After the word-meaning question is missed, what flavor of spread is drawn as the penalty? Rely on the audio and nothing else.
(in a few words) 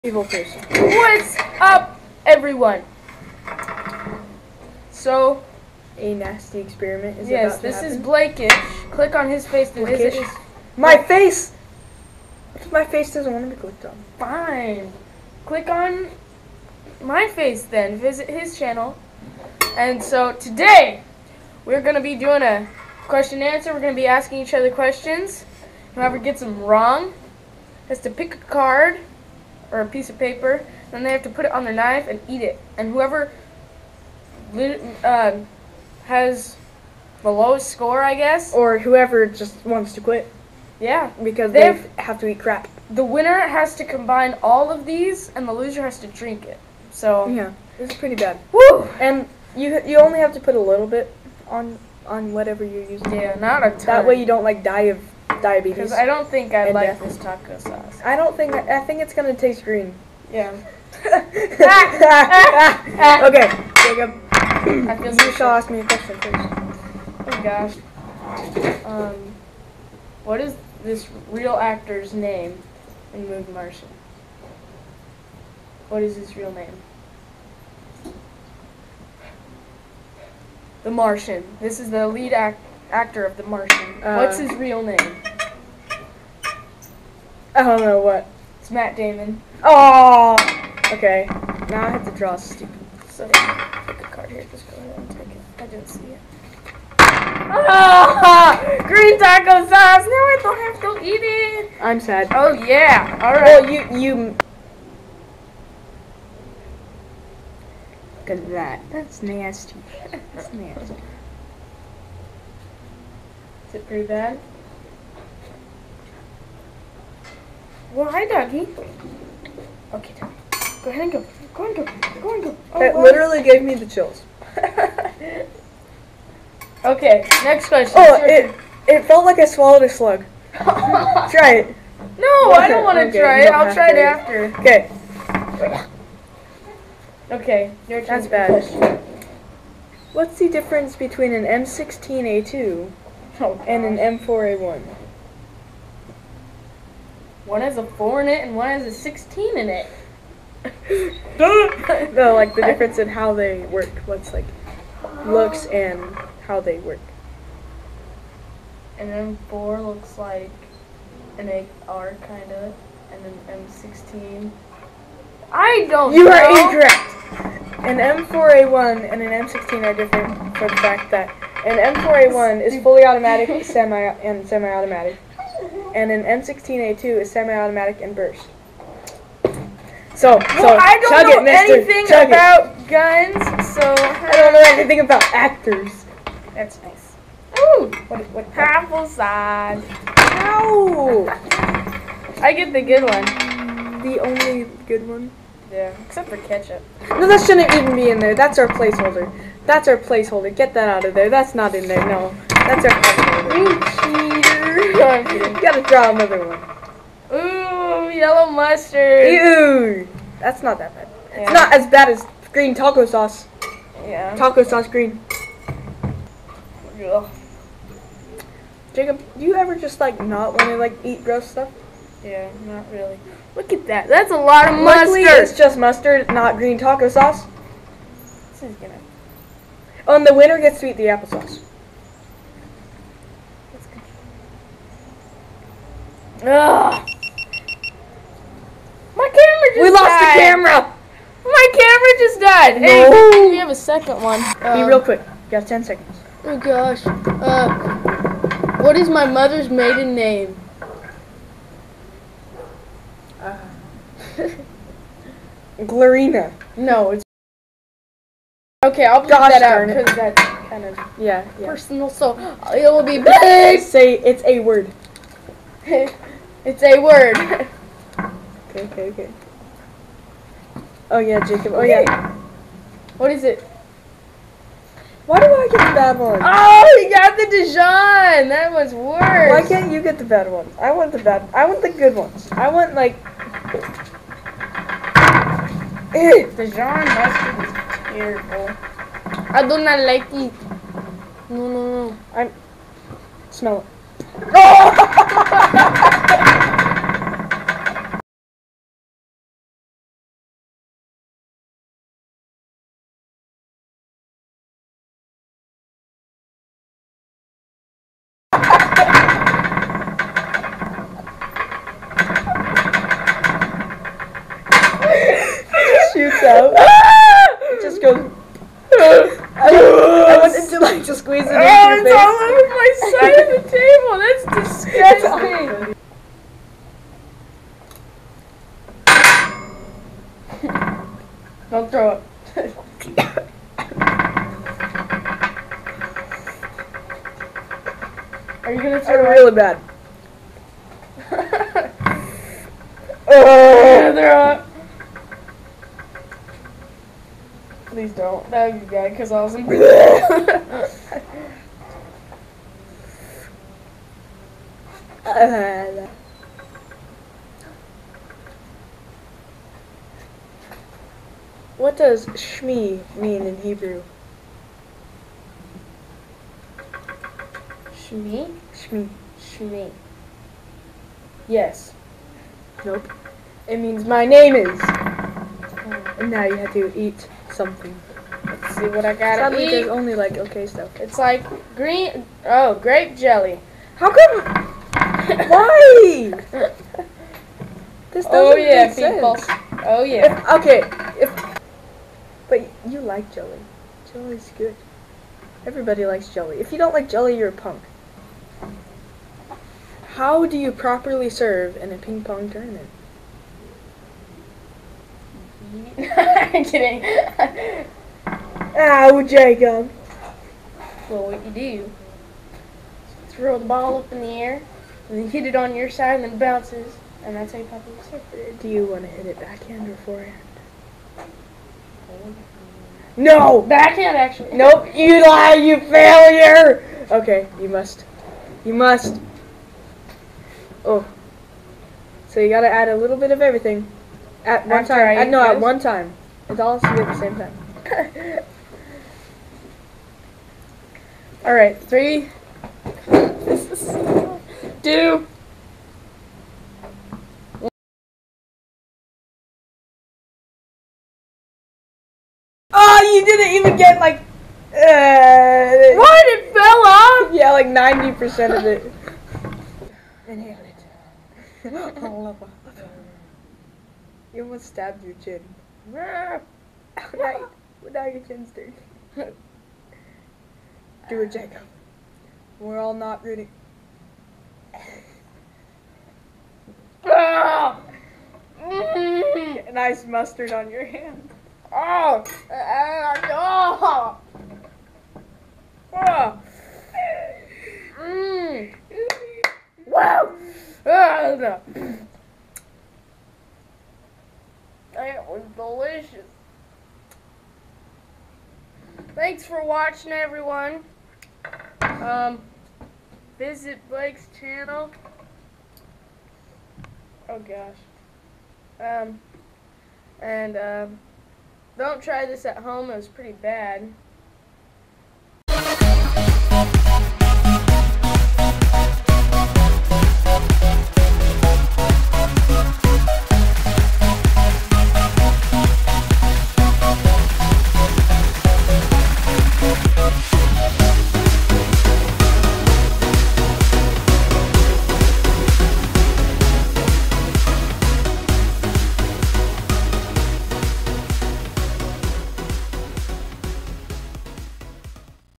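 Grape jelly.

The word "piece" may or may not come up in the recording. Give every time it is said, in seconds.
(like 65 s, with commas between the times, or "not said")
29 s.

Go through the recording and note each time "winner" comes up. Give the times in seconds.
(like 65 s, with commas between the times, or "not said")
43 s, 230 s.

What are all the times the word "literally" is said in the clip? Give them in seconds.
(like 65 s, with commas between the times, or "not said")
123 s.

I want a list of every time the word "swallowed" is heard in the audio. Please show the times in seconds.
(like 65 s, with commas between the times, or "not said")
129 s.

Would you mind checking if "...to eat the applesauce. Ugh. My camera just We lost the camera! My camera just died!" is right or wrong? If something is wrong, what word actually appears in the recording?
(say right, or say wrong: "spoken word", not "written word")
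right.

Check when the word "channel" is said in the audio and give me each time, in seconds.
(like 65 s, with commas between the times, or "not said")
18 s, 504 s.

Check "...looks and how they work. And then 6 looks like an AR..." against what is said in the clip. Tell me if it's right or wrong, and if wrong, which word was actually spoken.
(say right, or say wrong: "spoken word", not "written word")
wrong: "4", not "6".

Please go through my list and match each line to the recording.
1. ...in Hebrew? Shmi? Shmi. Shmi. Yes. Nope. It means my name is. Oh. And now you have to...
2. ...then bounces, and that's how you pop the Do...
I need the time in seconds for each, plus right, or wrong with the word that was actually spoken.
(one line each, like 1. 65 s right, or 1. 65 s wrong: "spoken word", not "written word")
1. 363 s right
2. 416 s right.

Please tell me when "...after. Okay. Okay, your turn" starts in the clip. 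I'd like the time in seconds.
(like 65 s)
133 s.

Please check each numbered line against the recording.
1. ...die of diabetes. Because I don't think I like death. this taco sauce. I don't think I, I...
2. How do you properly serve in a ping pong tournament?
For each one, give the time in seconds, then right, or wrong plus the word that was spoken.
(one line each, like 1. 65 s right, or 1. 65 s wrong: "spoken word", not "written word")
1. 54 s right
2. 400 s right.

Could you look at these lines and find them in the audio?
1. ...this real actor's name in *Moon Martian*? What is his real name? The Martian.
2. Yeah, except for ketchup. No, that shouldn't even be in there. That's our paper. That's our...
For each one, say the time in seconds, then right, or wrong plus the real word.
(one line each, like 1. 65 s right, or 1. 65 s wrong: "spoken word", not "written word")
1. 70 s right
2. 195 s wrong: "placeholder", not "paper".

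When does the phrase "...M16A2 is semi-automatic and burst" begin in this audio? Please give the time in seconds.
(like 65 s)
176 s.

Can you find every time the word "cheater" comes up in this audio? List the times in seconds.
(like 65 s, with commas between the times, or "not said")
205 s.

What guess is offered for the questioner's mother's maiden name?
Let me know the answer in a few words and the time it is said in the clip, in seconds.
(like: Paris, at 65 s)
Glorina, at 255 s.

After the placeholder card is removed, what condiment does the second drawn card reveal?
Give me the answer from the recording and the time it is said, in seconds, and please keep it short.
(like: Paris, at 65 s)
Yellow mustard, at 208 s.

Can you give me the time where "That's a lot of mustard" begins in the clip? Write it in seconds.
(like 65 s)
224 s.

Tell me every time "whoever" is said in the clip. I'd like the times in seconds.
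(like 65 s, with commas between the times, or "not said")
25 s, 32 s, 38 s.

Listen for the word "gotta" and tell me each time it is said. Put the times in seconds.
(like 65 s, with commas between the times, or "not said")
205 s, 432 s.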